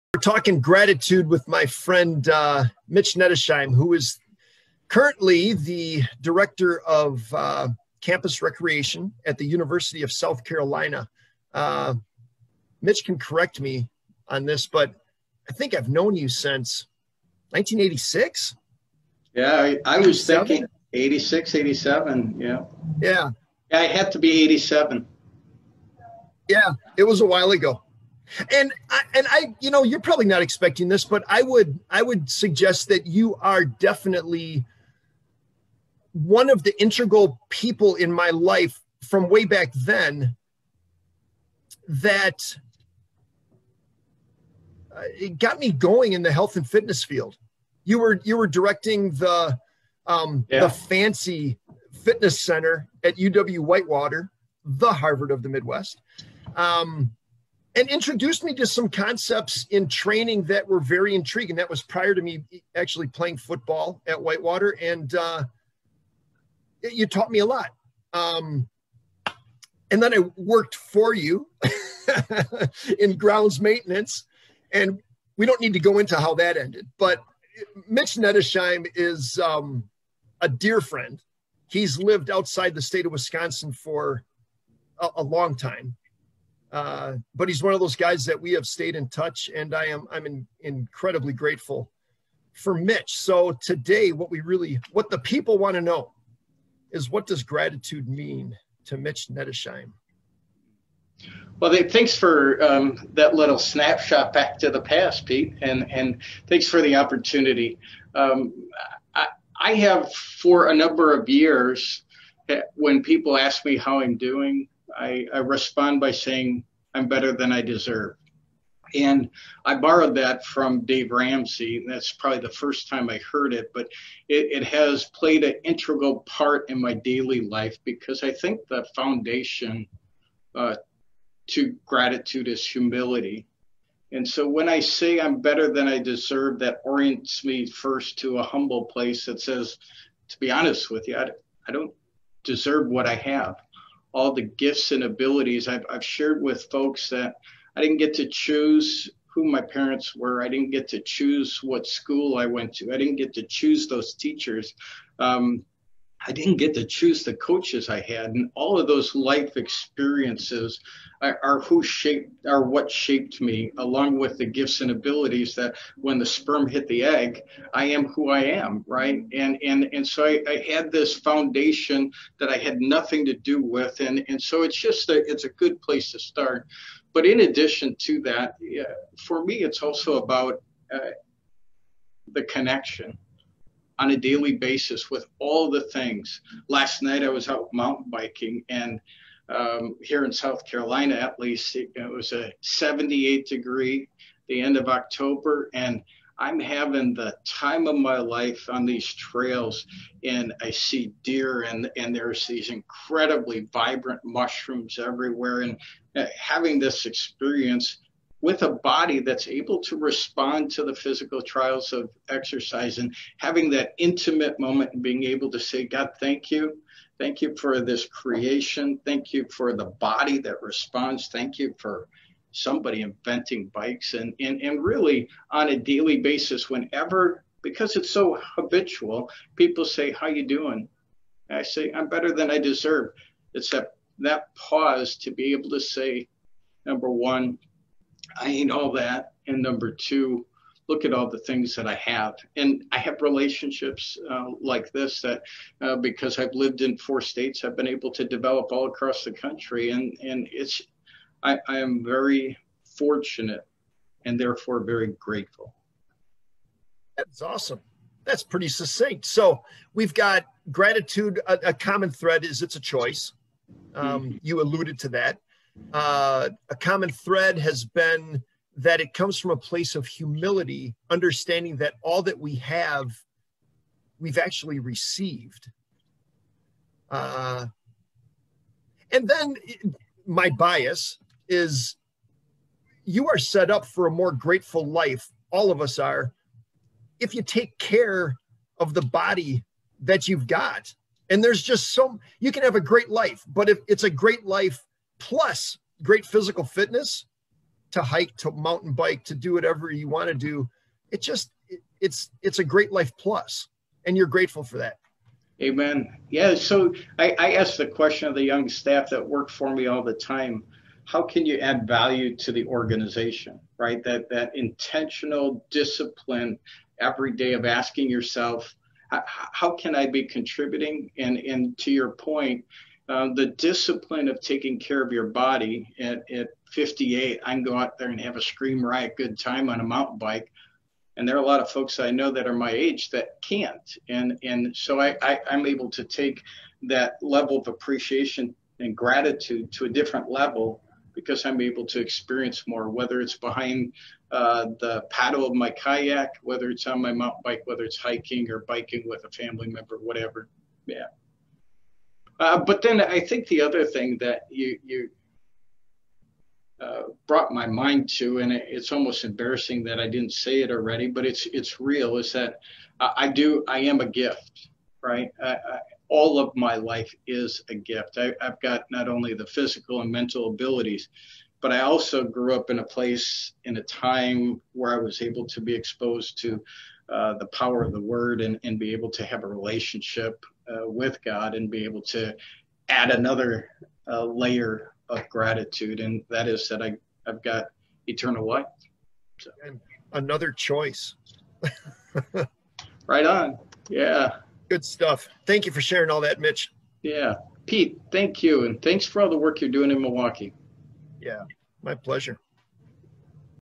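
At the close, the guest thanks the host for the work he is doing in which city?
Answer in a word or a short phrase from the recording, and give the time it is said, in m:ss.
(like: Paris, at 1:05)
Milwaukee, at 6:40.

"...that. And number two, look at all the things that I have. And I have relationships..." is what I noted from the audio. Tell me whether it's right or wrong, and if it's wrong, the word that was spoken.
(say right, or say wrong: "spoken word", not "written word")
right.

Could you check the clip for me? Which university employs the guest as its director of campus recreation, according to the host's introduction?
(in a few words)
University of South Carolina.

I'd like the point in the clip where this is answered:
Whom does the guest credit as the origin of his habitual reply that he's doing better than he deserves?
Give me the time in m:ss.
2:00.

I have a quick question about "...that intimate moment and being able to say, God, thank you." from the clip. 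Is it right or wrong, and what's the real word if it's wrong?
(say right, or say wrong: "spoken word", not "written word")
right.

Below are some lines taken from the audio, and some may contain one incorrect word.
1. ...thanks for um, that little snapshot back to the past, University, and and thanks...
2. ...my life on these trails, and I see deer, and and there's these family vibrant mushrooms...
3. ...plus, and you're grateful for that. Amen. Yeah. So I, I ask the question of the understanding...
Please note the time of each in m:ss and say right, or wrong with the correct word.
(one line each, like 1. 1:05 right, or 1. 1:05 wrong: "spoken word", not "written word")
1. 1:41 wrong: "Pete", not "University"
2. 3:17 wrong: "incredibly", not "family"
3. 5:03 wrong: "young", not "understanding".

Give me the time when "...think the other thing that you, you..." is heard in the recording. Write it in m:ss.
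5:53.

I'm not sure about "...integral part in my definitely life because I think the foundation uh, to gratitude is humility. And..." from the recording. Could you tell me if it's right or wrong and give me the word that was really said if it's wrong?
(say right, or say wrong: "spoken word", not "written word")
wrong: "daily", not "definitely".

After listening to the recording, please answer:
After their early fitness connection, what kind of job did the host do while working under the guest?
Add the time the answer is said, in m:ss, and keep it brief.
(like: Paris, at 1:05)
Grounds maintenance, at 1:13.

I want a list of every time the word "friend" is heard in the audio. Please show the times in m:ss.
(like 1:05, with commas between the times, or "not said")
0:01, 1:20.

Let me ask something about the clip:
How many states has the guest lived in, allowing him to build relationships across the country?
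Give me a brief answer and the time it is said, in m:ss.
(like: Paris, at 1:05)
4, at 4:06.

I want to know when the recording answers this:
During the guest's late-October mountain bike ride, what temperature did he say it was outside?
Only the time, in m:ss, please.
3:12.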